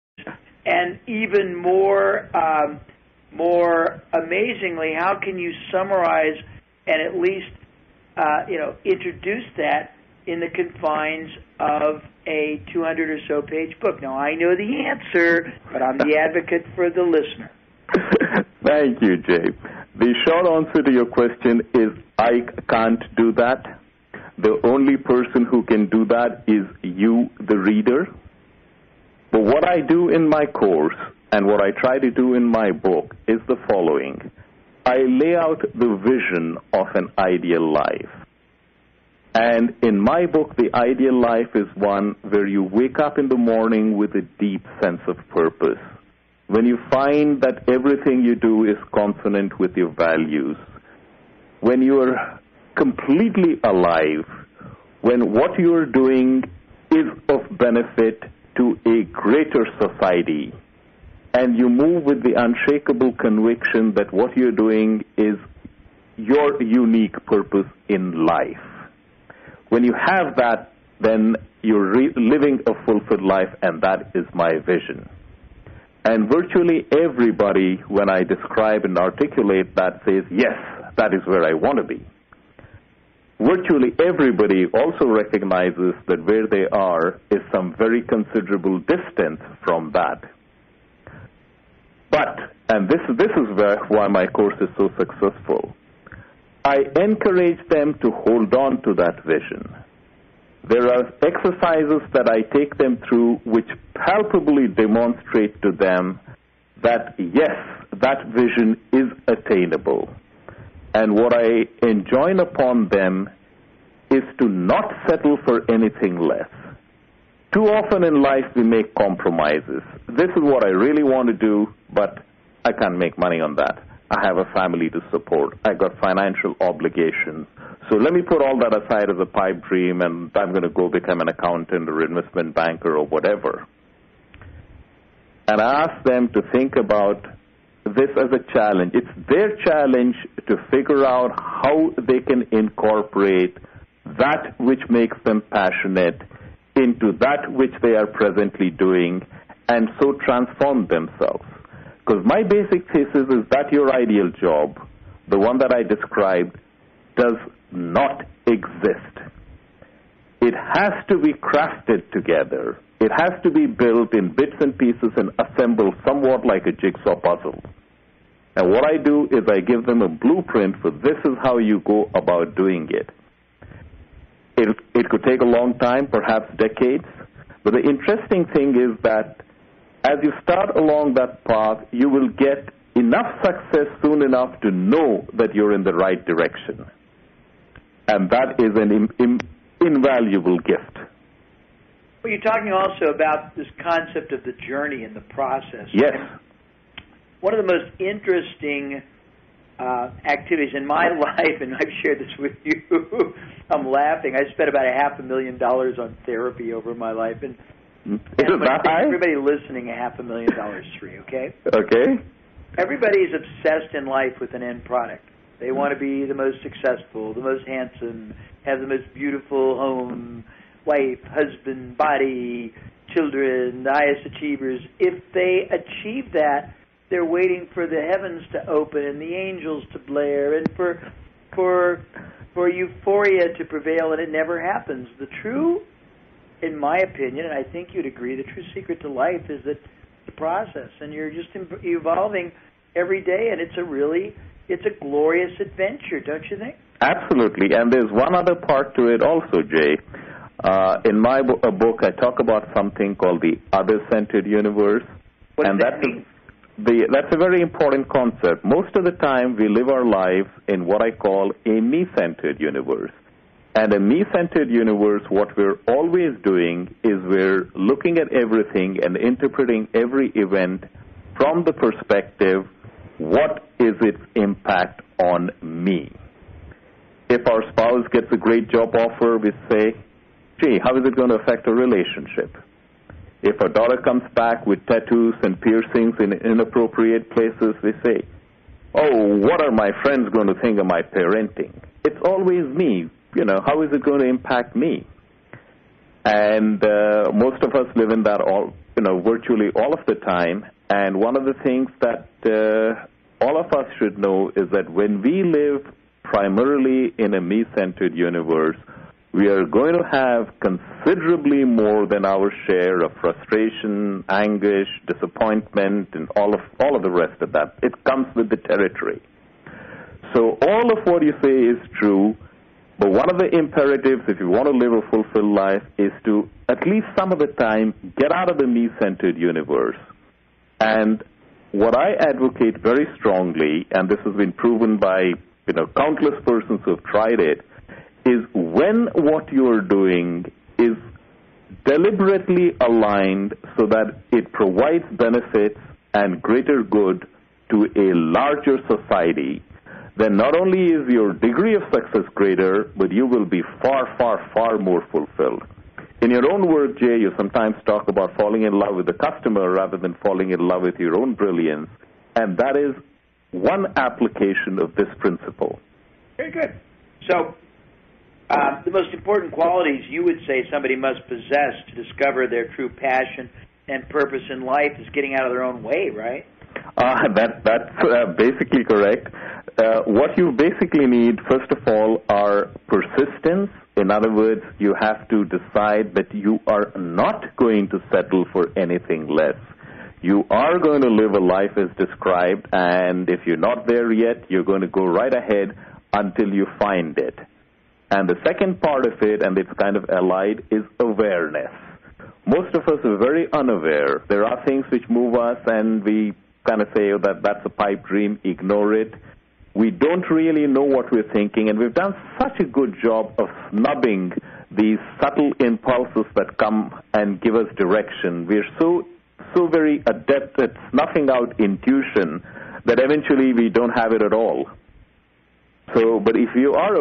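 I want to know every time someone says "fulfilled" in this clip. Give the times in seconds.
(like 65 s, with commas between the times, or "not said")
72 s, 325 s, 355 s.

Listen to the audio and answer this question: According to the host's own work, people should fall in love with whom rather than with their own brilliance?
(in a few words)
the customer.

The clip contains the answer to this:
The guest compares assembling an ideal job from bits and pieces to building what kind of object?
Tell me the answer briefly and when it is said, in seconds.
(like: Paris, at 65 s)
jigsaw puzzle, at 166 s.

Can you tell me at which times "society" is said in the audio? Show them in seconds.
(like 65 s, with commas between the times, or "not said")
59 s, 348 s.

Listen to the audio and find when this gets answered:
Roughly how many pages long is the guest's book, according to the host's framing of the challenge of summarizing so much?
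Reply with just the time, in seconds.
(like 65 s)
12 s.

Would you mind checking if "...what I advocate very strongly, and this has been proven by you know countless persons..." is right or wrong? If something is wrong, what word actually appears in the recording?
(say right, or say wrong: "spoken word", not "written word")
right.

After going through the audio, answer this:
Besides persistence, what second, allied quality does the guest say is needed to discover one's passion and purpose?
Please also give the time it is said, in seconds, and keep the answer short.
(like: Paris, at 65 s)
awareness, at 400 s.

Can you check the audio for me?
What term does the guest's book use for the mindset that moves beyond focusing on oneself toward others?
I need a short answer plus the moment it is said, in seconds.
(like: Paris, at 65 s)
other centered universe, at 253 s.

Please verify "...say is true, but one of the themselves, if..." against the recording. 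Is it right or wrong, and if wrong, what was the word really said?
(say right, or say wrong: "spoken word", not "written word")
wrong: "imperatives", not "themselves".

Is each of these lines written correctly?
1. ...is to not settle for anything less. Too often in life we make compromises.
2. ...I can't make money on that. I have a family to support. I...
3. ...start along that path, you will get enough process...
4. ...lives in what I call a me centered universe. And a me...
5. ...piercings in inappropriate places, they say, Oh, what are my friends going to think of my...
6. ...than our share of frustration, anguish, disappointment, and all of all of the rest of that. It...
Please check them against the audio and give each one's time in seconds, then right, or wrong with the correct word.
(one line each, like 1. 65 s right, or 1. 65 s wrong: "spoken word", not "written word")
1. 114 s right
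2. 122 s right
3. 180 s wrong: "success", not "process"
4. 260 s right
5. 285 s right
6. 312 s right.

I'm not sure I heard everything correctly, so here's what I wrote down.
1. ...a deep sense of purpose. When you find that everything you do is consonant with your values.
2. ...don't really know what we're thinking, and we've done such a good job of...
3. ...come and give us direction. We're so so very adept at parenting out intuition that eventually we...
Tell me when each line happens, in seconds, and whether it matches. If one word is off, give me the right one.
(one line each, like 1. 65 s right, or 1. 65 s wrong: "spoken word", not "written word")
1. 44 s right
2. 409 s right
3. 416 s wrong: "snuffing", not "parenting".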